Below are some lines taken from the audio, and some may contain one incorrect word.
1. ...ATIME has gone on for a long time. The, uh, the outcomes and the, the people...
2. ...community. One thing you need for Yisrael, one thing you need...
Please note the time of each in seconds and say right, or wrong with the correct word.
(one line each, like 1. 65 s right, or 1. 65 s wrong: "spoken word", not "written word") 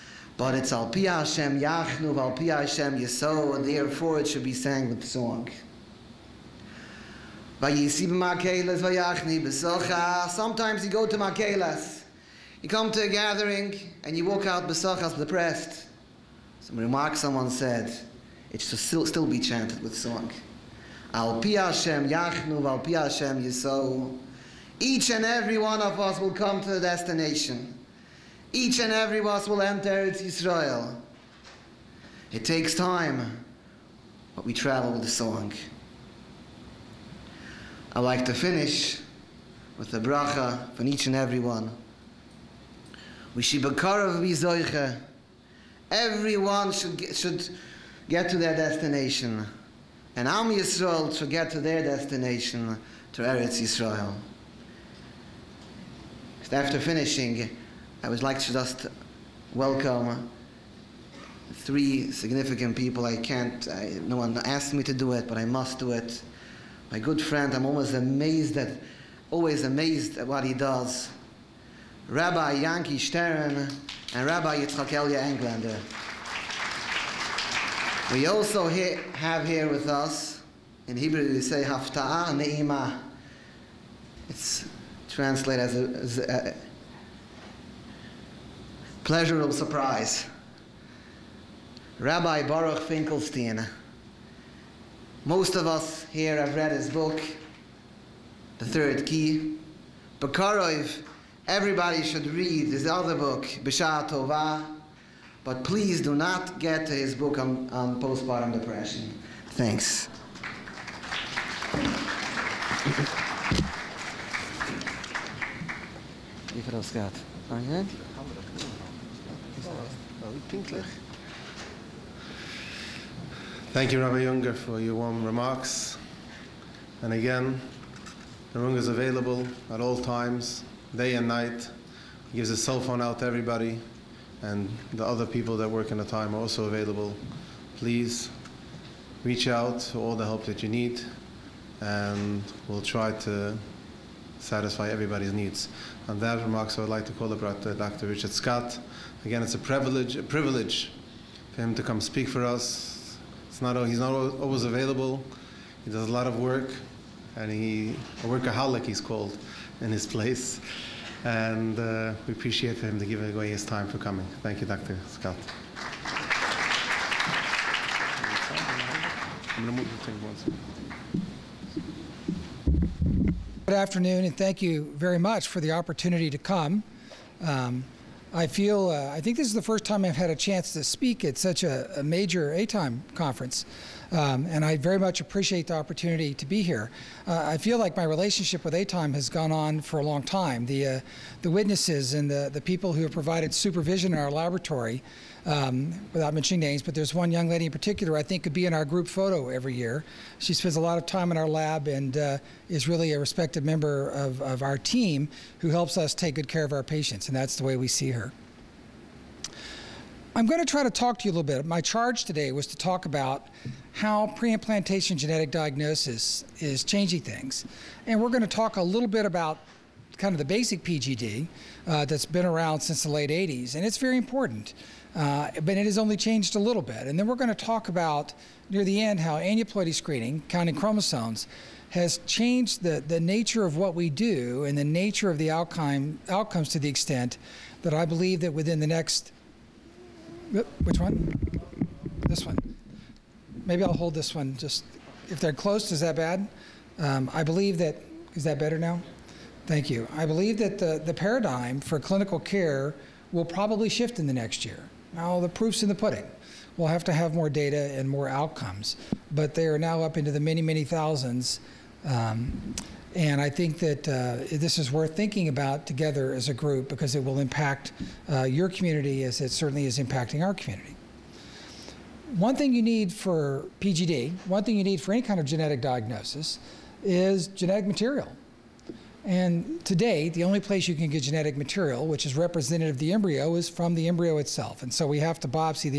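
1. 188 s wrong: "witnesses", not "outcomes"
2. 270 s wrong: "PGD", not "Yisrael".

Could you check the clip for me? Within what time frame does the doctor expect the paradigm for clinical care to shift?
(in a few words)
next year.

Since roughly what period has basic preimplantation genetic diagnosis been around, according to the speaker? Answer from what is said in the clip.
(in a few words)
late 80s.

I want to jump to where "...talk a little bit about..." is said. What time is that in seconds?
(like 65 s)
218 s.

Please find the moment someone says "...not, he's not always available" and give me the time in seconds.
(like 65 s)
153 s.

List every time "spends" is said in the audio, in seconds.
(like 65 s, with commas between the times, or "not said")
200 s.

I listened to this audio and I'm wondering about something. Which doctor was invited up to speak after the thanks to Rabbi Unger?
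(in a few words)
Dr. Richard Scott.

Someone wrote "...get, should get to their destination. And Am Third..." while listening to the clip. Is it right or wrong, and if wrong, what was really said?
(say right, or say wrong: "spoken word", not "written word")
wrong: "Yisrael", not "Third".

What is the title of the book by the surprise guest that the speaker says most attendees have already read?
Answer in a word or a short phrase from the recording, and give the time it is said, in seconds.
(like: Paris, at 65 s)
The Third Key, at 98 s.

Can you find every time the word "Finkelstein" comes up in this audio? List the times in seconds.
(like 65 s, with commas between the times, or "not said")
92 s.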